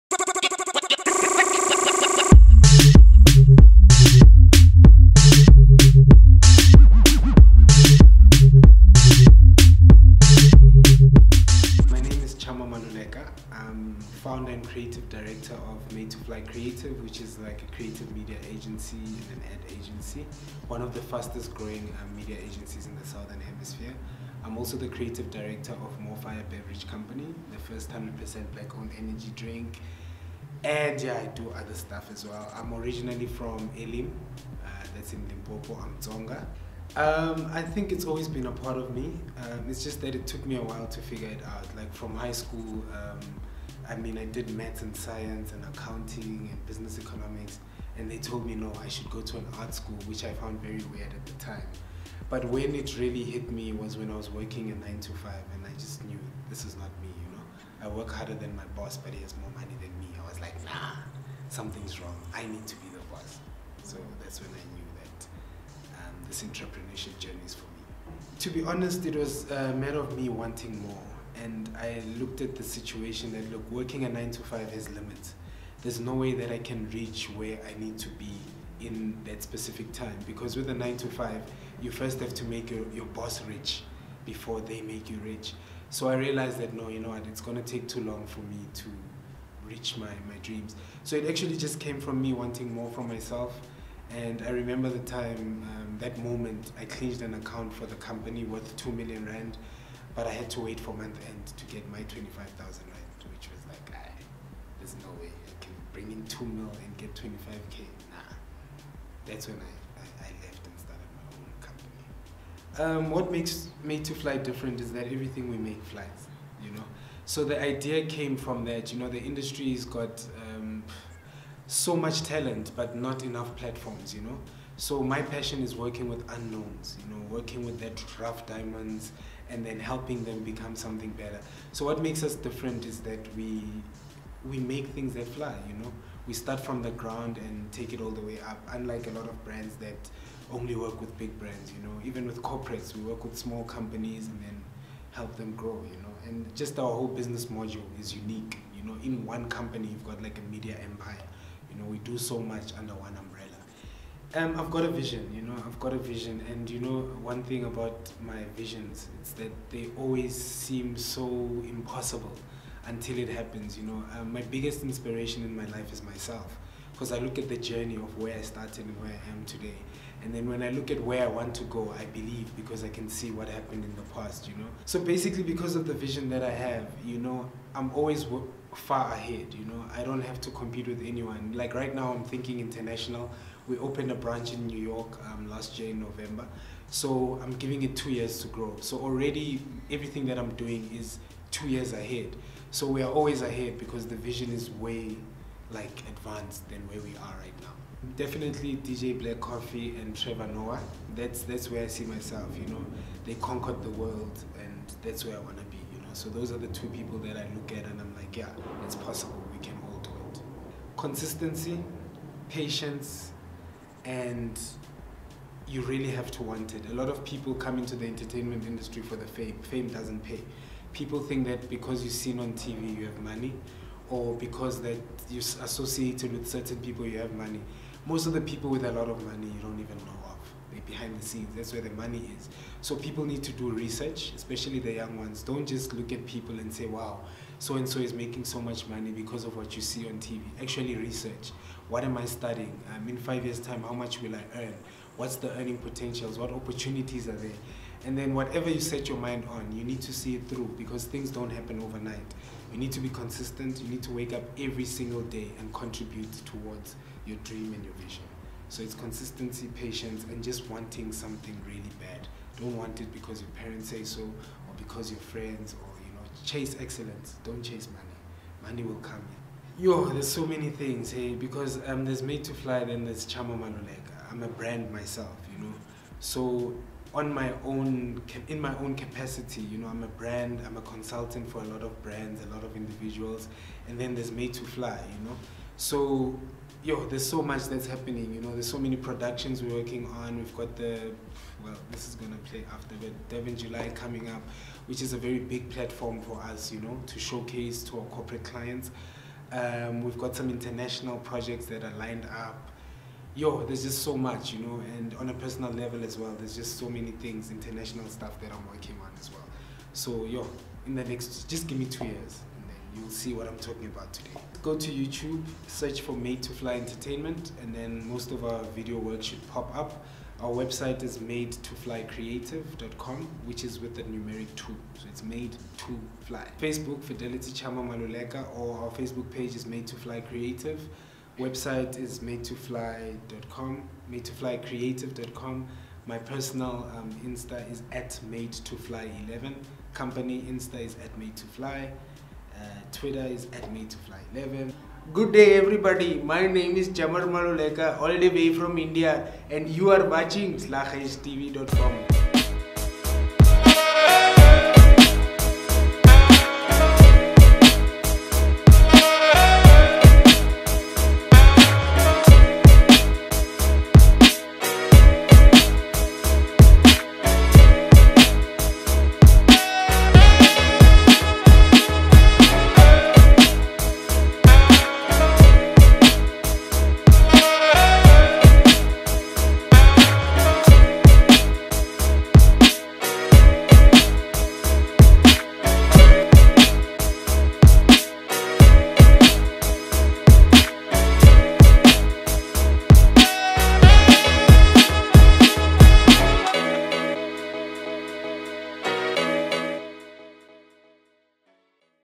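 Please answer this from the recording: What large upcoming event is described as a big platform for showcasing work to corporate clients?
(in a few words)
Durban July.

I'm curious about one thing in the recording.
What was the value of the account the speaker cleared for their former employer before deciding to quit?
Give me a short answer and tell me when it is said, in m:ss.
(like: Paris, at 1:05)
2 million rand, at 1:38.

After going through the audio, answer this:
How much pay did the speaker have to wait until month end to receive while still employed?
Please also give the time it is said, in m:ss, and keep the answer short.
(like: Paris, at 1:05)
25,000 rand, at 1:42.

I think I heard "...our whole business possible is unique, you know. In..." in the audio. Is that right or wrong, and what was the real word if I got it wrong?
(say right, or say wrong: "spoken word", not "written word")
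wrong: "module", not "possible".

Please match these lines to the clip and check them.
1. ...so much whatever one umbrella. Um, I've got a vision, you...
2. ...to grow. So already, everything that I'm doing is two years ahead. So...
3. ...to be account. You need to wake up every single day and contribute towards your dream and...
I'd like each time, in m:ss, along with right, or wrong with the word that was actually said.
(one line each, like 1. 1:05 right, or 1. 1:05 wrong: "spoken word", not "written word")
1. 2:32 wrong: "under", not "whatever"
2. 3:08 right
3. 4:12 wrong: "consistent", not "account".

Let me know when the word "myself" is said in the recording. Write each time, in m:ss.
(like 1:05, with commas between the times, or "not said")
1:33, 2:46, 3:22, 4:34.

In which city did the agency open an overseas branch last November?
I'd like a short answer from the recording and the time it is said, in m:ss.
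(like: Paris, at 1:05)
New York, at 3:04.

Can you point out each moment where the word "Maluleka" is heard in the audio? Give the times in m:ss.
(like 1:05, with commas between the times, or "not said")
0:12, 4:33, 5:27, 5:47.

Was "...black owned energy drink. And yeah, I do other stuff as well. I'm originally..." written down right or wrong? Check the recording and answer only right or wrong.
right.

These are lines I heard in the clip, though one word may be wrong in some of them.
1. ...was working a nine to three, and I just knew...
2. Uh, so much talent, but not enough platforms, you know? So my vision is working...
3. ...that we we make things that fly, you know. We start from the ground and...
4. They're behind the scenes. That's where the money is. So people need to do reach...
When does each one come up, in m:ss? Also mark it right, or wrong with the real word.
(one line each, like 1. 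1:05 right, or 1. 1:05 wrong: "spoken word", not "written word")
1. 0:54 wrong: "five", not "three"
2. 2:00 wrong: "passion", not "vision"
3. 2:13 right
4. 3:50 wrong: "research", not "reach".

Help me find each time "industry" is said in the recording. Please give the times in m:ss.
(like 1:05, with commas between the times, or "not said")
1:59, 3:38.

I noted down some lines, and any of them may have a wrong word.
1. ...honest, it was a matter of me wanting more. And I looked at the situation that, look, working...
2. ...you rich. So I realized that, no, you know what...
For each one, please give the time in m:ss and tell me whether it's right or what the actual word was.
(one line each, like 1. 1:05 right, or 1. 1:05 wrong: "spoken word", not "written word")
1. 1:08 right
2. 1:25 right.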